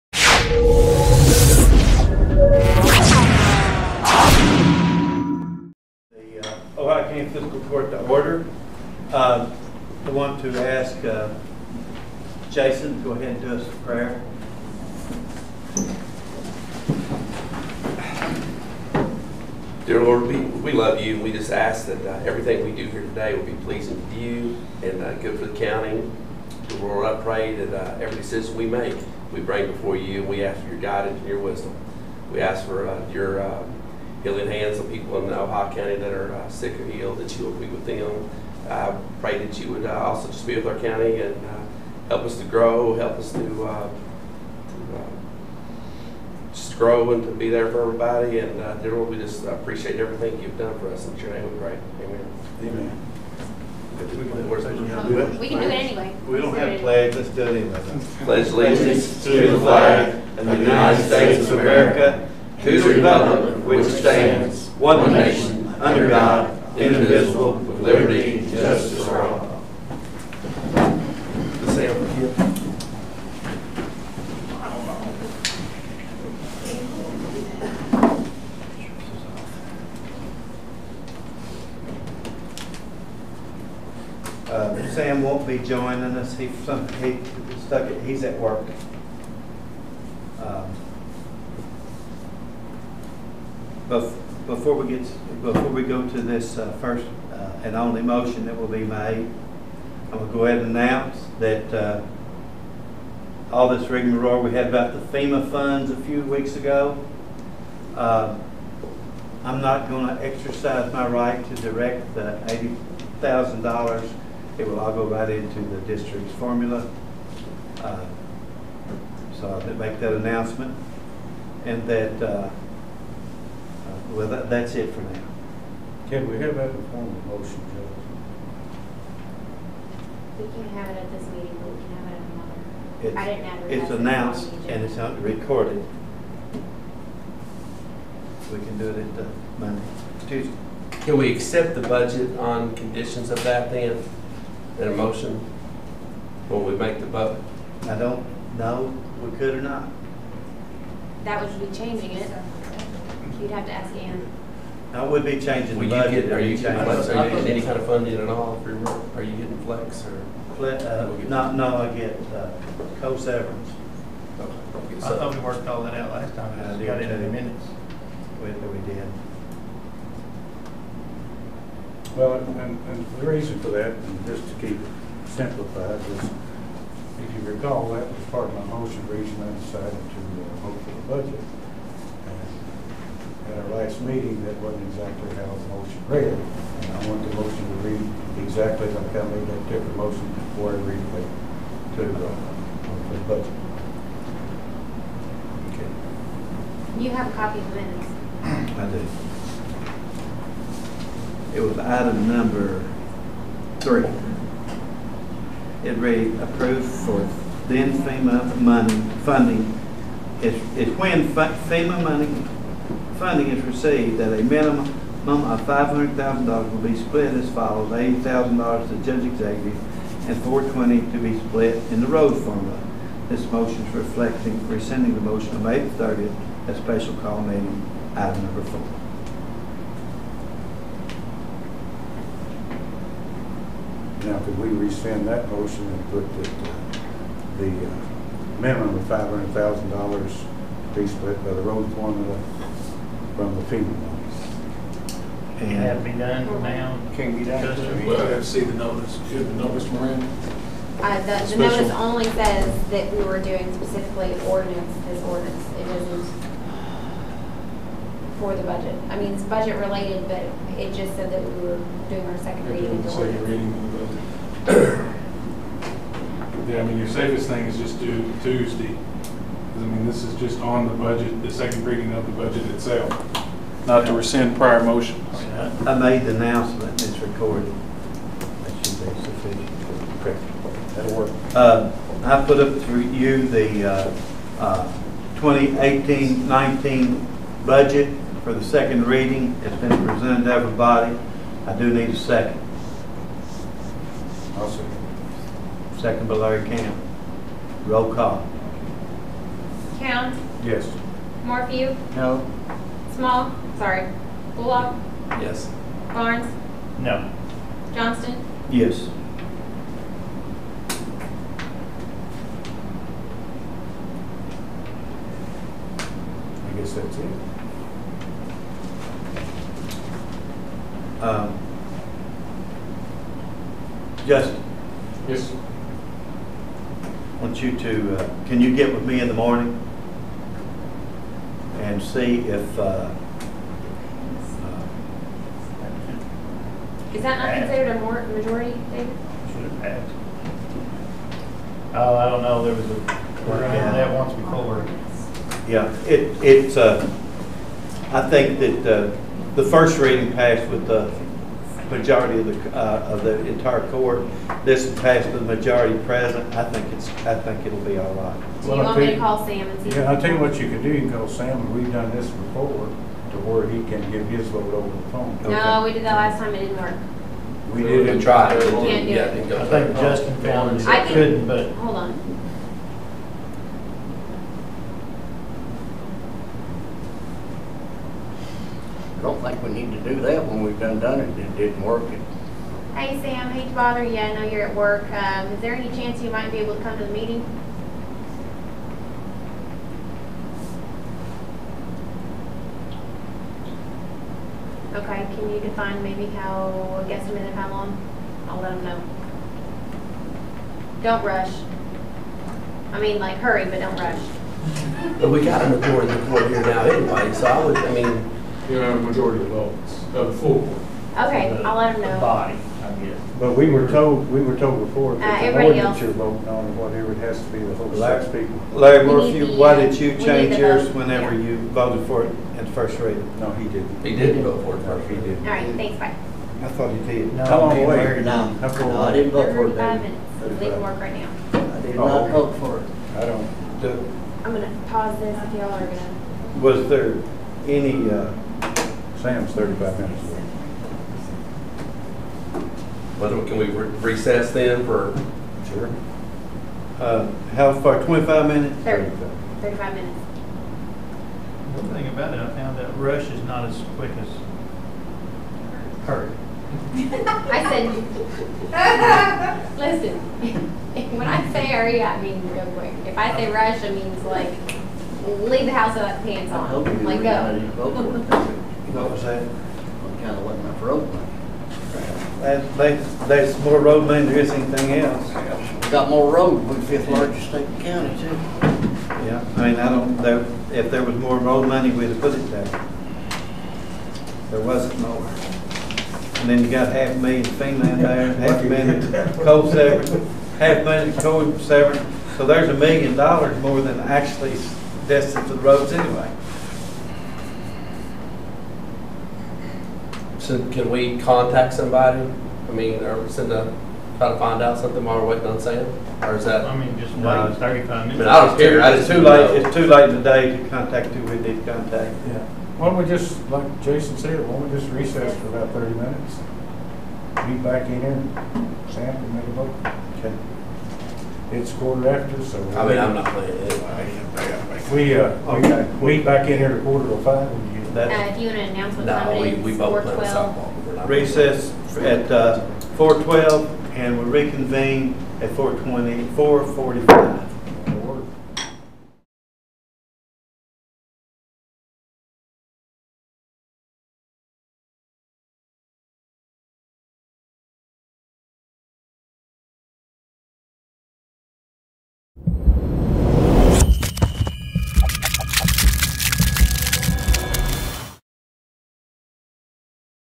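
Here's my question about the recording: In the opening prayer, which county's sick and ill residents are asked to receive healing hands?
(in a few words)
Ohio County.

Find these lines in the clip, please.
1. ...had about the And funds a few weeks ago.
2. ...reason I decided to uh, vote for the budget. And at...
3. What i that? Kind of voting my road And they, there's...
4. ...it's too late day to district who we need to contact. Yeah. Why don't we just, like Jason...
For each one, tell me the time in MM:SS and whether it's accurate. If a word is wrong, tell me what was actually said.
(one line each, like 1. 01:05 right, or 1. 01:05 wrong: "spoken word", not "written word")
1. 01:44 wrong: "FEMA", not "And"
2. 02:59 right
3. 07:47 wrong: "letting", not "voting"
4. 08:29 wrong: "contact", not "district".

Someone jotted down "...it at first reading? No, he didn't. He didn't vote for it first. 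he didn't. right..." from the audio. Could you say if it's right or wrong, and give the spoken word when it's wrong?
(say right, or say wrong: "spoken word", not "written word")
right.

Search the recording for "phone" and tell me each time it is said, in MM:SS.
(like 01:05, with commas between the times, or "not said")
06:05.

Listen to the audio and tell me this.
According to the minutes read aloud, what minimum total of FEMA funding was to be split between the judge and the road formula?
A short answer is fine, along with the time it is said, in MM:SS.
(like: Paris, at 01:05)
$500,000, at 03:35.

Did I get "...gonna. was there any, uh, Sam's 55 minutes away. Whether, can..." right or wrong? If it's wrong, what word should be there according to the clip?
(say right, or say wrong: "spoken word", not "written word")
wrong: "35", not "55".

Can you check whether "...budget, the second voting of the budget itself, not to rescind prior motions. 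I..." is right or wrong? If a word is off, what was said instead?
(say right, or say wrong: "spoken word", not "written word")
wrong: "reading", not "voting".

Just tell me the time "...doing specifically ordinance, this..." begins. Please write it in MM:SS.
04:13.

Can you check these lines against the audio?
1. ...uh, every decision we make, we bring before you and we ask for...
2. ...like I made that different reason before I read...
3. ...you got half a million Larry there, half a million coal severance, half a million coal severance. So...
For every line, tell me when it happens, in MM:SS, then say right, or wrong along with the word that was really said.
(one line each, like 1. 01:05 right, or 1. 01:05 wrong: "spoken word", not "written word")
1. 00:27 right
2. 03:08 wrong: "motion", not "reason"
3. 08:06 wrong: "Finland", not "Larry".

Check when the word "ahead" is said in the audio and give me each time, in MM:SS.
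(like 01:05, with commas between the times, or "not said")
00:13, 01:40.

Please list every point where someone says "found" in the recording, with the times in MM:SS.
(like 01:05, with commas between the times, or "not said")
06:10, 07:32.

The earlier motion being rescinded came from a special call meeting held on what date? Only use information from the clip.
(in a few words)
May 30.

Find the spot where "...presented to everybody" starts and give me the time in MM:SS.
04:50.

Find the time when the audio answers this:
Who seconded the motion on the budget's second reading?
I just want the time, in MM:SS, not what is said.
04:56.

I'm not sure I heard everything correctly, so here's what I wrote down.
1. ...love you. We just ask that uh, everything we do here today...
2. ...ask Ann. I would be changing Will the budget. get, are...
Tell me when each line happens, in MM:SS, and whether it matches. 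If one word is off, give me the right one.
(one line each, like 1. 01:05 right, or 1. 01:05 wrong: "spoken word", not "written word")
1. 00:20 right
2. 02:33 right.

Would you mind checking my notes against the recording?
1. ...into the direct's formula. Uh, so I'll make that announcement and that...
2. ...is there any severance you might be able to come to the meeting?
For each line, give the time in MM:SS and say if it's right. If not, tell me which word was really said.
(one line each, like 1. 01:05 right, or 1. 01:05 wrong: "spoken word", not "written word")
1. 01:55 wrong: "district", not "direct"
2. 06:25 wrong: "chance", not "severance".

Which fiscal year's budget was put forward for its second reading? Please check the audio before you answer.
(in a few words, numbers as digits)
2018-19.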